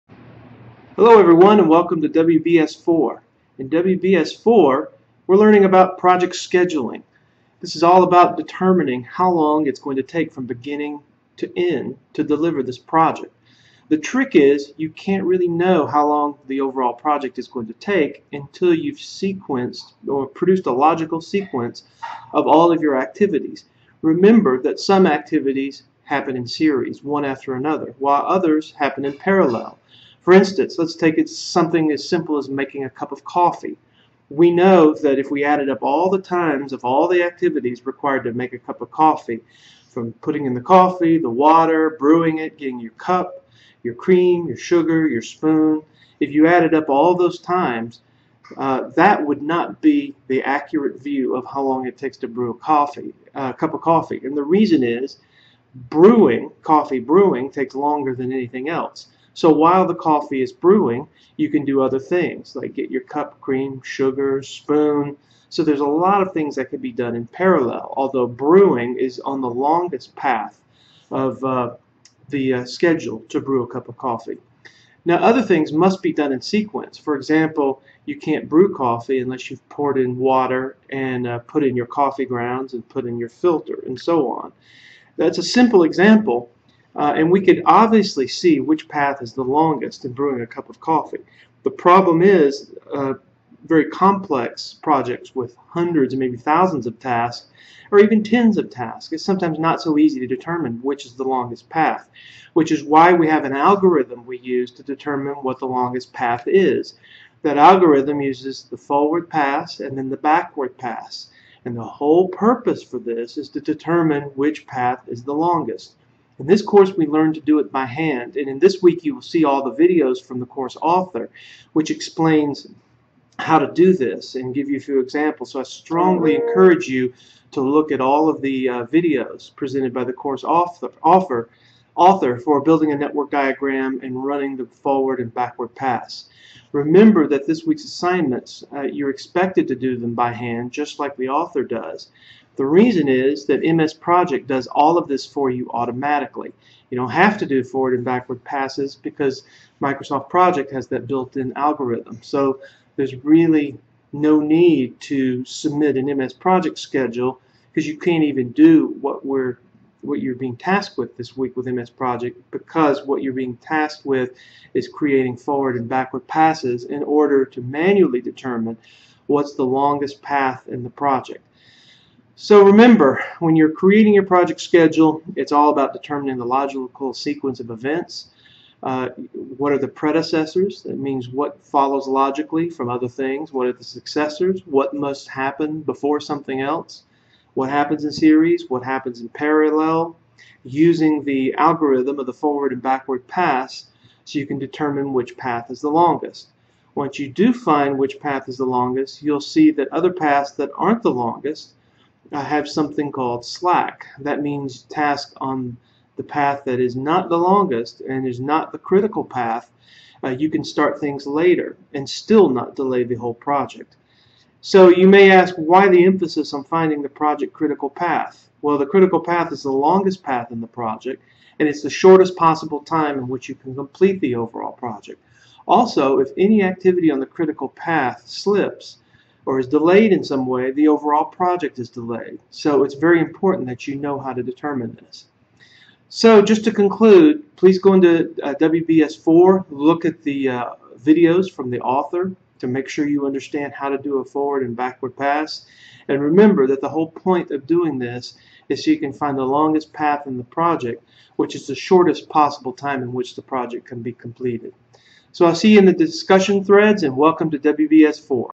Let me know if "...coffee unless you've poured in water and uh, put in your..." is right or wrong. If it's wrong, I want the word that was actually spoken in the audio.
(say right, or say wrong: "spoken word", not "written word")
right.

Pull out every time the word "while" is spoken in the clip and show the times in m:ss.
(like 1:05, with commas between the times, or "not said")
0:27, 0:59.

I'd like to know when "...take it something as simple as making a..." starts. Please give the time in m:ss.
0:30.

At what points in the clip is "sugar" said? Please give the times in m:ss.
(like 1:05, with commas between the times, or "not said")
0:44, 1:03.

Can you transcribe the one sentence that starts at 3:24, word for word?
That means task on the path that is not the longest and is not the critical path.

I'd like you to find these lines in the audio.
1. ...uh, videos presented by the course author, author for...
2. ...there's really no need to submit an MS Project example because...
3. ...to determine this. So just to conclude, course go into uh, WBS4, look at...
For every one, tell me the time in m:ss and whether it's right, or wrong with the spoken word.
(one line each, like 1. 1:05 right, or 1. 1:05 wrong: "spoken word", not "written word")
1. 2:08 right
2. 2:32 wrong: "schedule", not "example"
3. 3:54 wrong: "please", not "course".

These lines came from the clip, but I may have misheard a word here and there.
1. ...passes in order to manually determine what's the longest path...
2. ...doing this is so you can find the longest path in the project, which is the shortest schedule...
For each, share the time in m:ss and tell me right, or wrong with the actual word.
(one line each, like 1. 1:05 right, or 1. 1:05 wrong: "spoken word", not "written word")
1. 2:46 right
2. 4:07 wrong: "possible", not "schedule".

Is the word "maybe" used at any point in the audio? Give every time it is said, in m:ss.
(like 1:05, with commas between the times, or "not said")
1:36.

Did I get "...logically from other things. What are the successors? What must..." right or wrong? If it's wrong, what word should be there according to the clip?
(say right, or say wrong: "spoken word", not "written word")
right.